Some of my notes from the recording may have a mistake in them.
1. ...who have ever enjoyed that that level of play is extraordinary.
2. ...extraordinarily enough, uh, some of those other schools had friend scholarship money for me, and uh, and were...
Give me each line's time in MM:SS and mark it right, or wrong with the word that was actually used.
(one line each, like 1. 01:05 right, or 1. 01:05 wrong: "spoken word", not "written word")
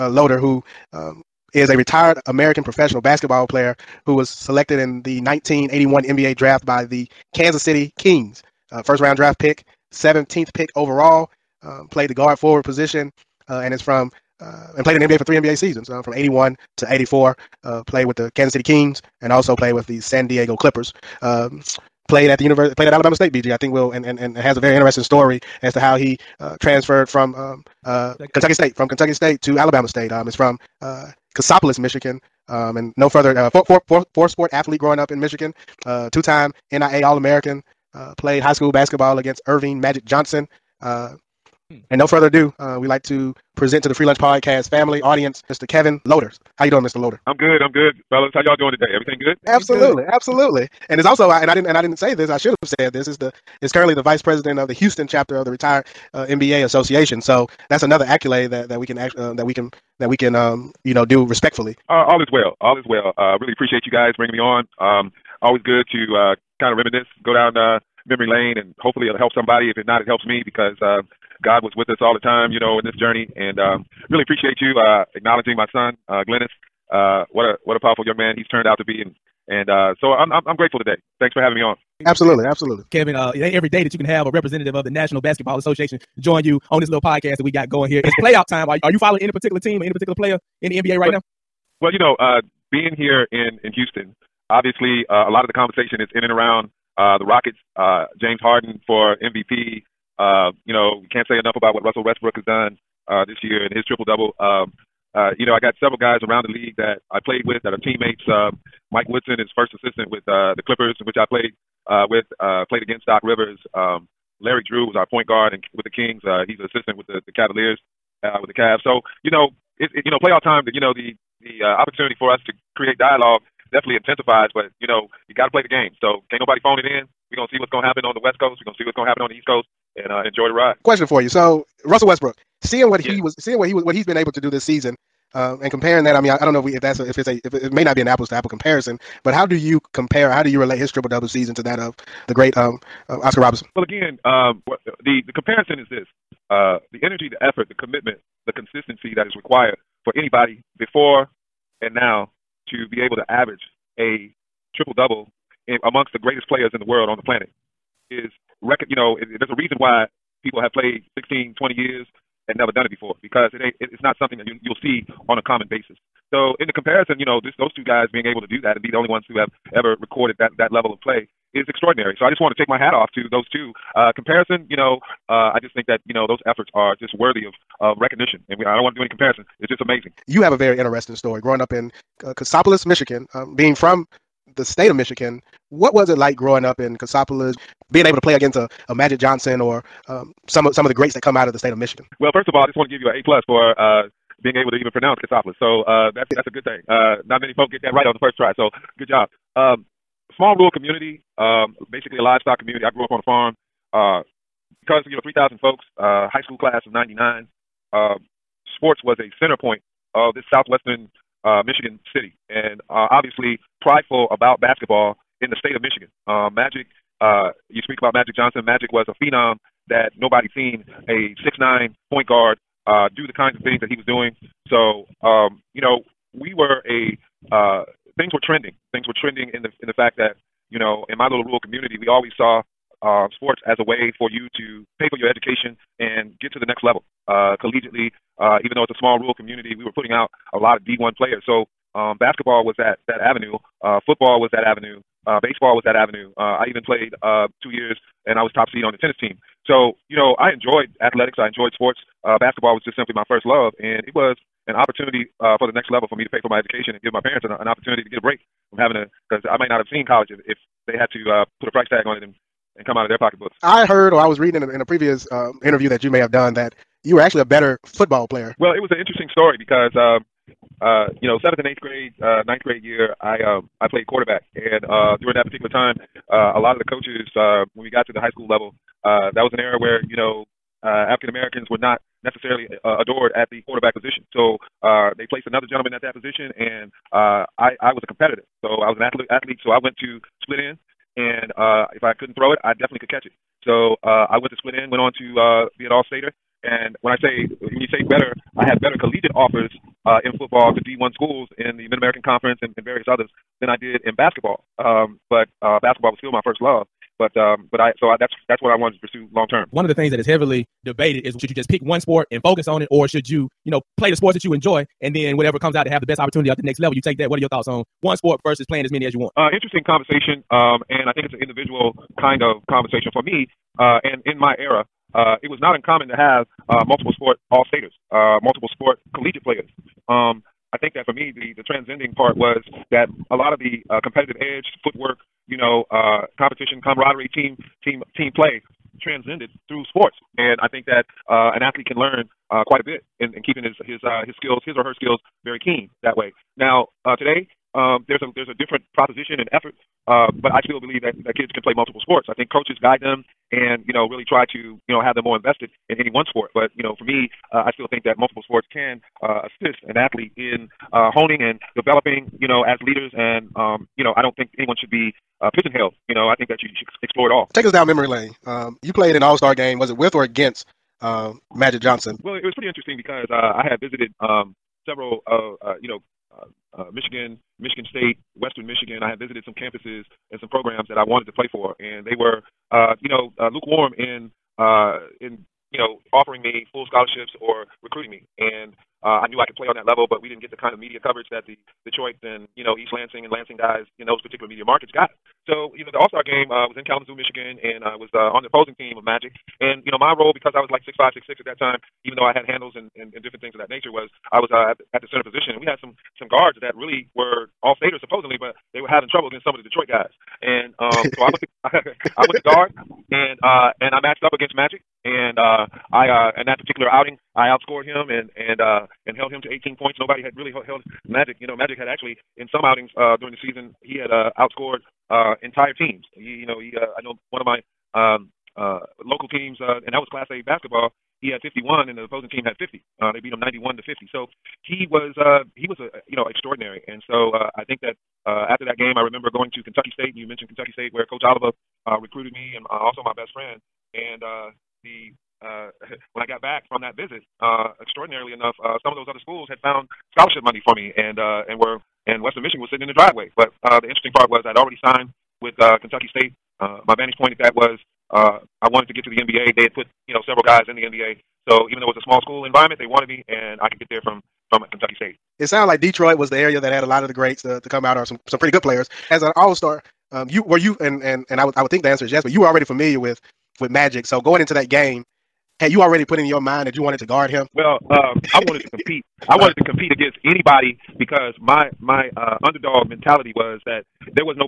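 1. 02:49 wrong: "recorded", not "enjoyed"
2. 07:27 wrong: "found", not "friend".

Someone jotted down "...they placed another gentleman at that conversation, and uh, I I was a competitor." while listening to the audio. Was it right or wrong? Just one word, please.
wrong.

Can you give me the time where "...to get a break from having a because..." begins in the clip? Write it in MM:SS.
04:18.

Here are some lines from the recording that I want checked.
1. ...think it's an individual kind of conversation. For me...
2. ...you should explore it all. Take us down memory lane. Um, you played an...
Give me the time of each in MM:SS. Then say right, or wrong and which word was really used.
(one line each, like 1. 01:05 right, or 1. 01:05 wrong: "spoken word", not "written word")
1. 05:21 right
2. 06:06 right.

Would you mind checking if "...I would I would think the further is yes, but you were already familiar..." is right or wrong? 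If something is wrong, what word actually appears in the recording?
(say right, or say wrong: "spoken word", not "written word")
wrong: "answer", not "further".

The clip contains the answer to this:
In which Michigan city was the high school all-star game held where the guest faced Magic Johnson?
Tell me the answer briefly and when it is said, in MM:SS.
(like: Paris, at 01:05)
Kalamazoo, at 06:36.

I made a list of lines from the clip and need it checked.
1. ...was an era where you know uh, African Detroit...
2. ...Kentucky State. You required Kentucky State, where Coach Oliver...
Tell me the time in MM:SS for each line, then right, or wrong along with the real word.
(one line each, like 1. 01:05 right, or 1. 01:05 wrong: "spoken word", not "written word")
1. 04:39 wrong: "Americans", not "Detroit"
2. 07:19 wrong: "mentioned", not "required".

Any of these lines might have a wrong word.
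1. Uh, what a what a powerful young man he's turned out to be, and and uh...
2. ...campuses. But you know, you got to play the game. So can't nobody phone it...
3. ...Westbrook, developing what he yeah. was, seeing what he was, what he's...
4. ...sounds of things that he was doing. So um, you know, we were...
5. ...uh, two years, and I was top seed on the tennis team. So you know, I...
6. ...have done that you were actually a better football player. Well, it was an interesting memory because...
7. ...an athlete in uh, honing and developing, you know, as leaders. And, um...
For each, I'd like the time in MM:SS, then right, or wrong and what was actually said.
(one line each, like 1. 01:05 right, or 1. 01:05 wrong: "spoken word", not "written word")
1. 01:16 right
2. 02:03 wrong: "intensifies", not "campuses"
3. 02:12 wrong: "seeing", not "developing"
4. 03:43 wrong: "kinds", not "sounds"
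5. 04:07 right
6. 04:26 wrong: "story", not "memory"
7. 05:59 right.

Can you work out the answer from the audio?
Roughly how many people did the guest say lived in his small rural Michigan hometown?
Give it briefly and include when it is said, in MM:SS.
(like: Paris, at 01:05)
3000, at 03:25.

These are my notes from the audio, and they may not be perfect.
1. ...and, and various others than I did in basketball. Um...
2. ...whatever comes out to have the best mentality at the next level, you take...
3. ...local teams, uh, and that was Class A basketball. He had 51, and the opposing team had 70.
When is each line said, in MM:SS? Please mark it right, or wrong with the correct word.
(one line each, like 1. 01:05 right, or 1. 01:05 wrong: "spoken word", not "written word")
1. 05:02 right
2. 05:15 wrong: "opportunity", not "mentality"
3. 07:09 wrong: "50", not "70".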